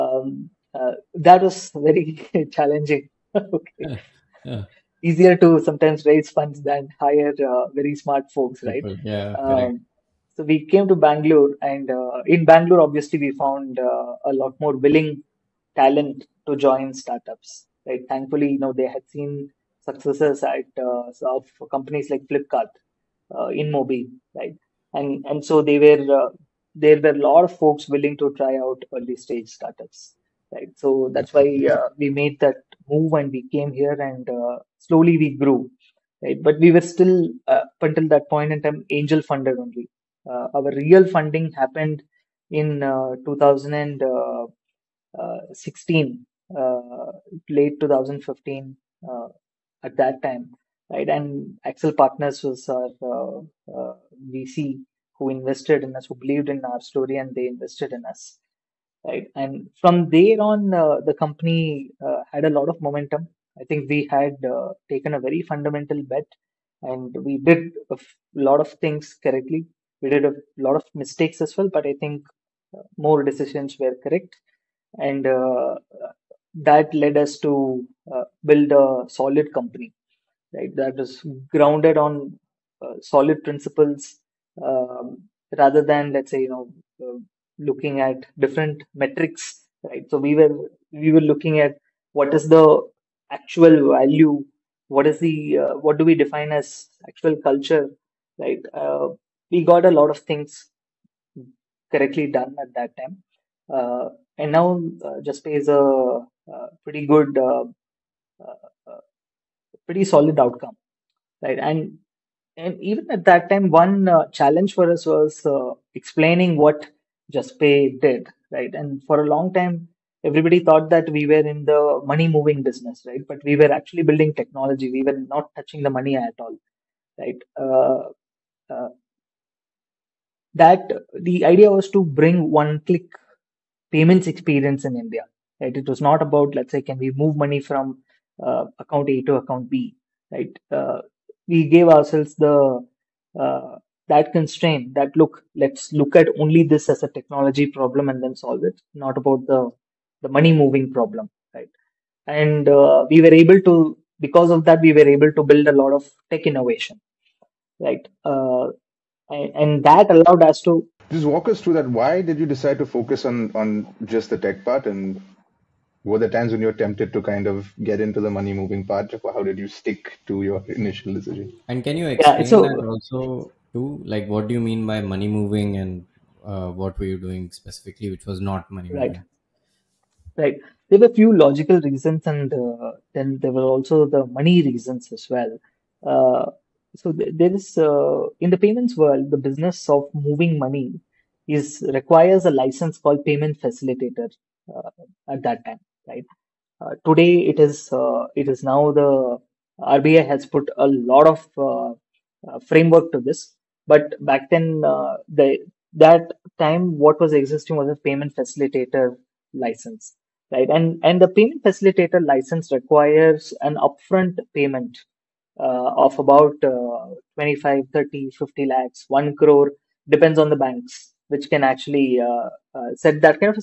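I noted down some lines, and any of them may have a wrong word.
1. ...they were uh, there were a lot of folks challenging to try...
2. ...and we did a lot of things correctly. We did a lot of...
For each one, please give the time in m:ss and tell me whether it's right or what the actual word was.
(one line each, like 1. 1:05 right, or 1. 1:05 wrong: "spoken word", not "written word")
1. 0:25 wrong: "willing", not "challenging"
2. 1:06 right.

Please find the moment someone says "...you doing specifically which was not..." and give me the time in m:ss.
2:57.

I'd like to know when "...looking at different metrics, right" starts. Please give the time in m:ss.
1:27.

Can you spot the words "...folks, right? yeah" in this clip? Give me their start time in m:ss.
0:08.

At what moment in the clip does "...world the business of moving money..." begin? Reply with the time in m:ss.
3:09.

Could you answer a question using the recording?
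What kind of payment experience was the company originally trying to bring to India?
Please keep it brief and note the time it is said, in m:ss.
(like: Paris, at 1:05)
One click payments, at 2:12.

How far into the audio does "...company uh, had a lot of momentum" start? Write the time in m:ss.
1:01.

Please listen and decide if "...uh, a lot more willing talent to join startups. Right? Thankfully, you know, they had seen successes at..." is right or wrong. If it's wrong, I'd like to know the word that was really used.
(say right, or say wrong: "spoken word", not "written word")
right.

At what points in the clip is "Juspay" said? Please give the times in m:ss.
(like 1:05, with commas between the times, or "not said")
1:57.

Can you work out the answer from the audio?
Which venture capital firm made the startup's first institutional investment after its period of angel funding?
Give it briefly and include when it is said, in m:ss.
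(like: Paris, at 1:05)
Accel Partners, at 0:51.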